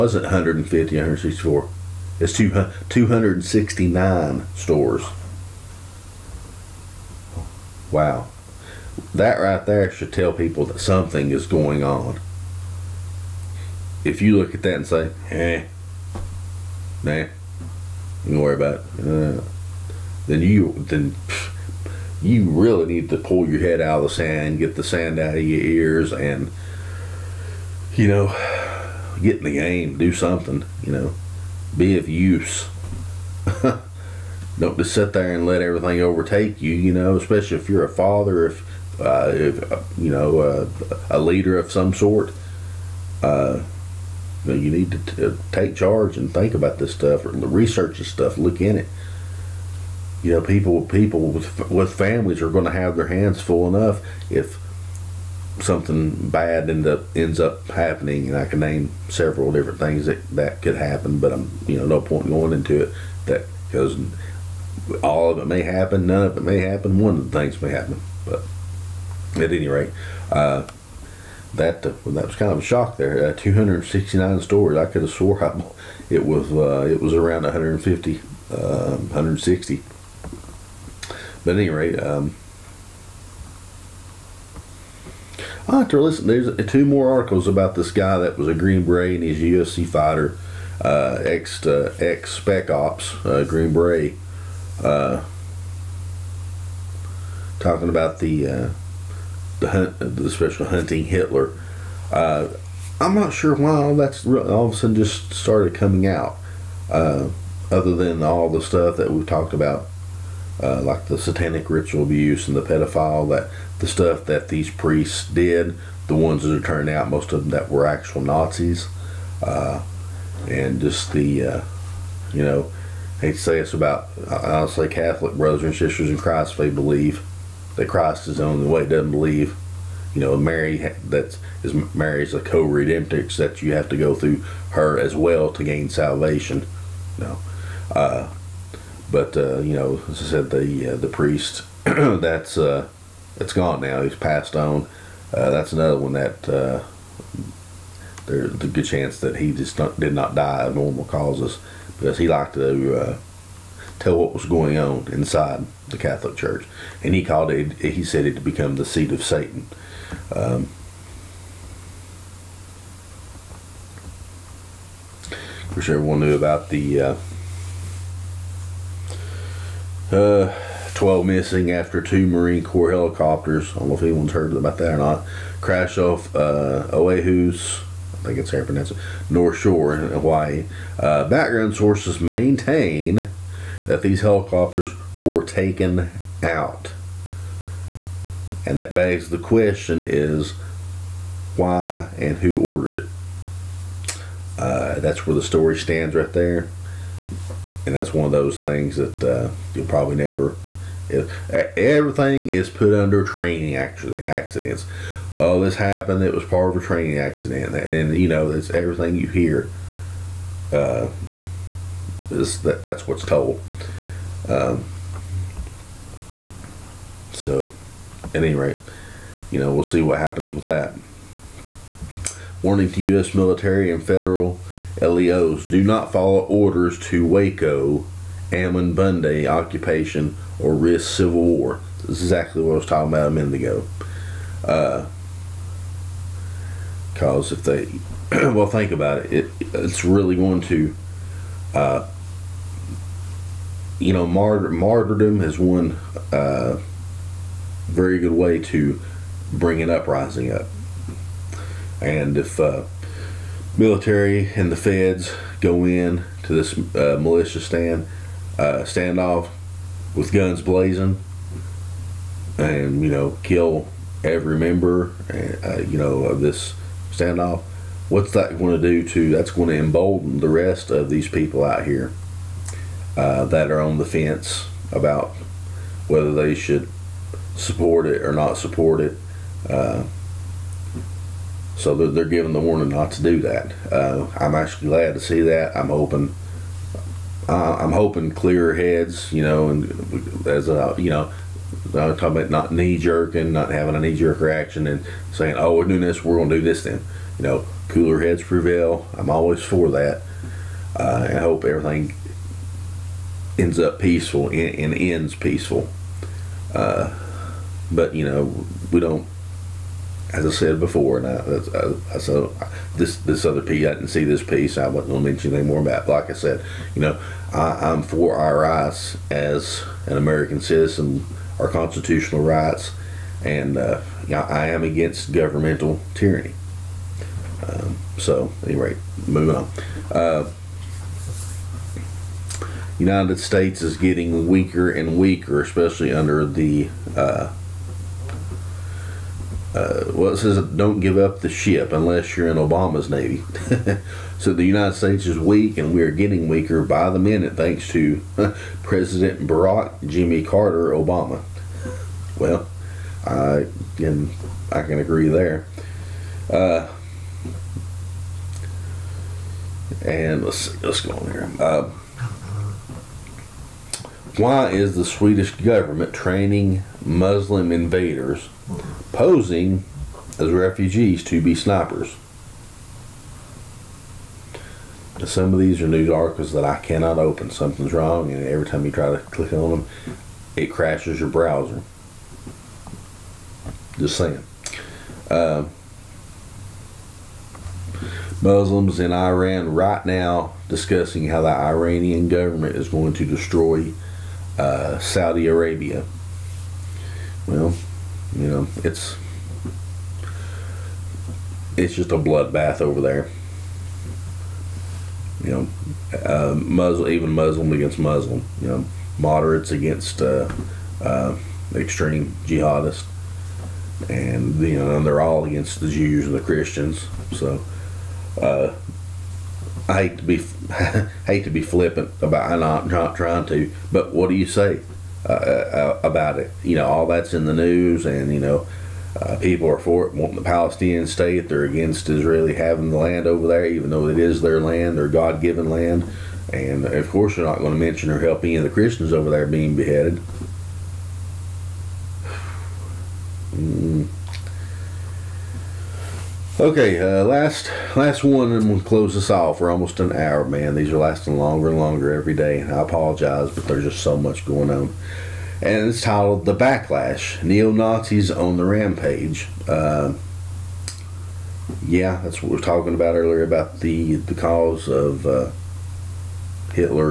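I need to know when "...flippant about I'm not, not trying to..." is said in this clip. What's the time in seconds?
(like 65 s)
421 s.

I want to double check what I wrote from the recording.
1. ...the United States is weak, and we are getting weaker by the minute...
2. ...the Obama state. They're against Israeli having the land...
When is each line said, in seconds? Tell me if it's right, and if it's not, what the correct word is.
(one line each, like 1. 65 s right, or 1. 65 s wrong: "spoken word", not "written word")
1. 344 s right
2. 430 s wrong: "Palestinian", not "Obama".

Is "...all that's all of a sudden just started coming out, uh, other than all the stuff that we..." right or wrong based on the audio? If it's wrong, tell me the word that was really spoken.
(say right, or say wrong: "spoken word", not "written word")
right.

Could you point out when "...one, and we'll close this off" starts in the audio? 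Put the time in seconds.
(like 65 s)
448 s.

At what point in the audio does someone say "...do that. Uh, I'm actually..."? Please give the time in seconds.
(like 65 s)
283 s.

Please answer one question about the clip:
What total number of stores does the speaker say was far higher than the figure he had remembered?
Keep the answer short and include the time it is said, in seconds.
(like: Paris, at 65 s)
269, at 2 s.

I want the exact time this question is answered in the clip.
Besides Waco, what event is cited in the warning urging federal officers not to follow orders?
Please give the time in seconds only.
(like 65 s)
228 s.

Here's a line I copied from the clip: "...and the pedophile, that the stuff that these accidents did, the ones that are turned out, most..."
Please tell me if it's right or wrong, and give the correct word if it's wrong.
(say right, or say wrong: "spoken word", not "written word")
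wrong: "priests", not "accidents".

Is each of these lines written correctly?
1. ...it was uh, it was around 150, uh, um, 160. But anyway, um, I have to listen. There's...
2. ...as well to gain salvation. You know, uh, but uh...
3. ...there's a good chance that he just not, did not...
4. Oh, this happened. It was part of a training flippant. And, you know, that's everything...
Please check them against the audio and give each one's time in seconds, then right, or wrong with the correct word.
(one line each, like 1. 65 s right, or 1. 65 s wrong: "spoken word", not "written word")
1. 76 s right
2. 134 s right
3. 148 s right
4. 205 s wrong: "accident", not "flippant".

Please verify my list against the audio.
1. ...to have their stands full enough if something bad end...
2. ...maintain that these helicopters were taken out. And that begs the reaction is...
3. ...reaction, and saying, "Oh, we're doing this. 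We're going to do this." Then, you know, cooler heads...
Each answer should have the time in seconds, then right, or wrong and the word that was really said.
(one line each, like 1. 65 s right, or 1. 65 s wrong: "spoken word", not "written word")
1. 52 s wrong: "hands", not "stands"
2. 182 s wrong: "question", not "reaction"
3. 294 s right.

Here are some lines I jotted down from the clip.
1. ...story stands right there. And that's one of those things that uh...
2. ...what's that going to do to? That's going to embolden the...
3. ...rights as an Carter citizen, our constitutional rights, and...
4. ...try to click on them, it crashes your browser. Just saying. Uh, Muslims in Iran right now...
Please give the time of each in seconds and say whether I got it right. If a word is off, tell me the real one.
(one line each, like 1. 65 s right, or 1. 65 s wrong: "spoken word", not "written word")
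1. 195 s right
2. 268 s right
3. 318 s wrong: "American", not "Carter"
4. 378 s right.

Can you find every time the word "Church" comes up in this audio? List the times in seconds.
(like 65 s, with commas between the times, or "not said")
156 s.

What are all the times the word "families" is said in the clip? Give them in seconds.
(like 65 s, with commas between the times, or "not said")
51 s.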